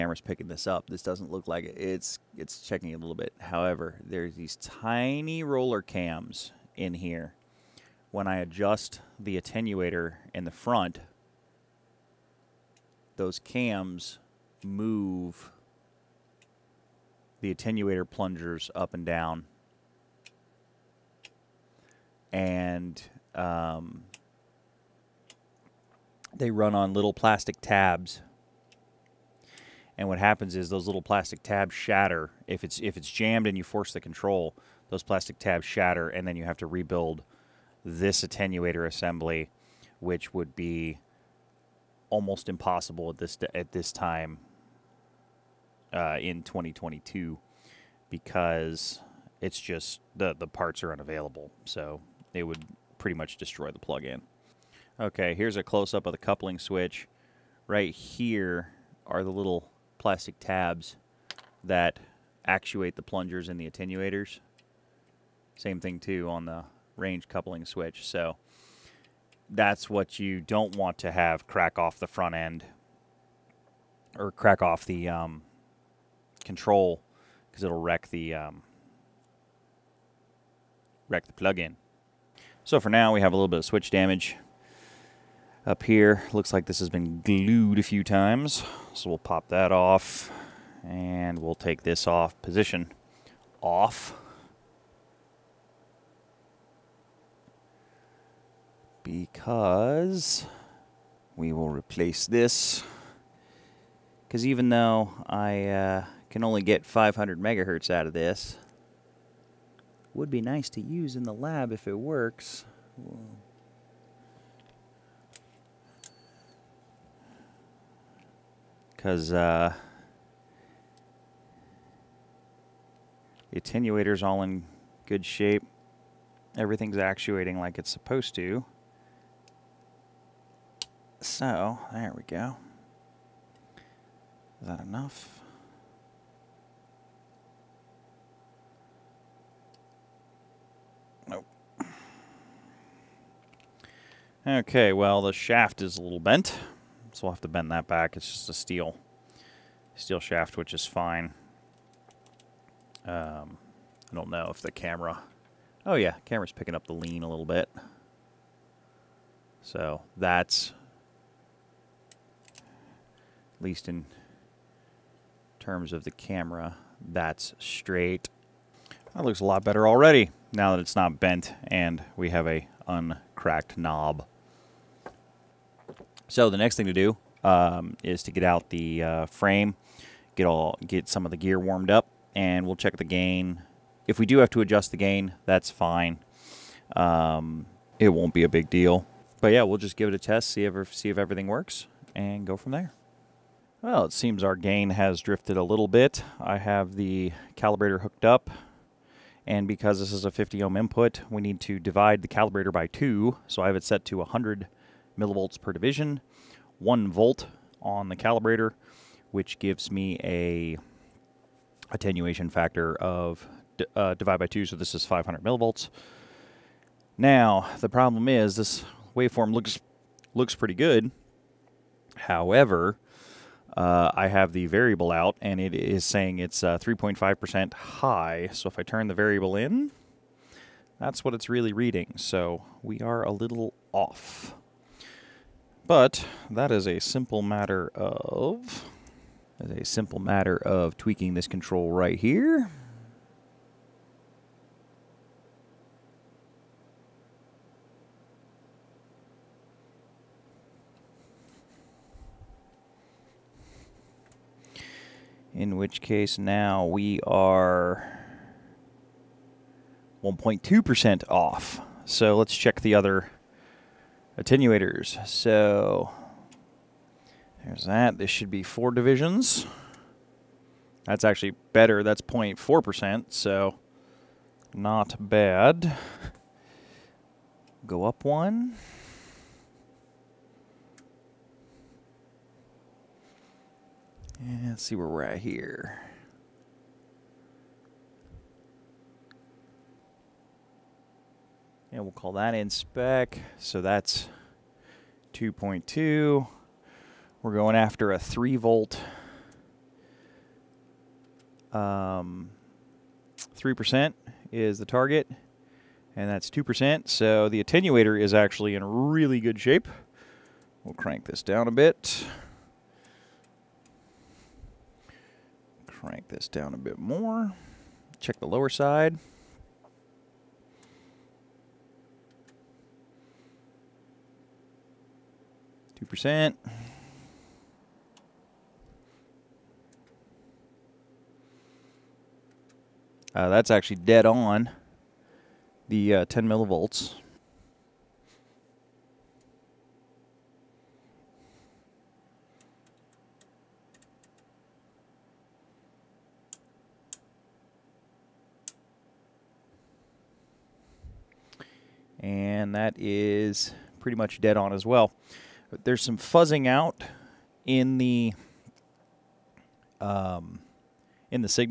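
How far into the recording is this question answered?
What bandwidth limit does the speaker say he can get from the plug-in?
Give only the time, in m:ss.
1:46.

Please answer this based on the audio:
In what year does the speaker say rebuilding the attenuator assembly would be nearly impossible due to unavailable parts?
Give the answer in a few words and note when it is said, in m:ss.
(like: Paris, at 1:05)
2022, at 0:46.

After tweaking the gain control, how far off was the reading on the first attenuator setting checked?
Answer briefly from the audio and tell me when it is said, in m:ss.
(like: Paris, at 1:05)
1.2%, at 4:20.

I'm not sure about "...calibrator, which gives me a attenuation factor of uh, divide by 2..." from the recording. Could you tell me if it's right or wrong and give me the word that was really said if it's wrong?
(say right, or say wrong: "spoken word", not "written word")
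right.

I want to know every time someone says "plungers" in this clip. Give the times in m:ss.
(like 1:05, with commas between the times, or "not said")
0:18, 1:03.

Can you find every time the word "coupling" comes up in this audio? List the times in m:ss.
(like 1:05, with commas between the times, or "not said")
0:56, 1:07.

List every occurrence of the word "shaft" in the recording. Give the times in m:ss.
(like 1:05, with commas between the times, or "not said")
2:25, 2:30.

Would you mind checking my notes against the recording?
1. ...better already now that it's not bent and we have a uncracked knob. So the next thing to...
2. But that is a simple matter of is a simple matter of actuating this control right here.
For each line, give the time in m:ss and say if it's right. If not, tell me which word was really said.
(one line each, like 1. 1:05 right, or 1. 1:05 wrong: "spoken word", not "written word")
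1. 2:49 right
2. 3:55 wrong: "tweaking", not "actuating".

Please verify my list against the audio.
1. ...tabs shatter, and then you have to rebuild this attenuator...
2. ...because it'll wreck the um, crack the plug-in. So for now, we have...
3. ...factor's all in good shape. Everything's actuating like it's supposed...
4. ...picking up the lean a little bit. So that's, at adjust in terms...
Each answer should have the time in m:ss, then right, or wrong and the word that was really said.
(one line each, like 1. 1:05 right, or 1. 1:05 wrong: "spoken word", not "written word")
1. 0:35 right
2. 1:17 wrong: "wreck", not "crack"
3. 2:03 wrong: "attenuator", not "factor"
4. 2:36 wrong: "least", not "adjust".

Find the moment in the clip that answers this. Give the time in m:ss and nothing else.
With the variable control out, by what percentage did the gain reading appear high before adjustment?
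3:46.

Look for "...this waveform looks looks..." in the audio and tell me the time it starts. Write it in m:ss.
3:38.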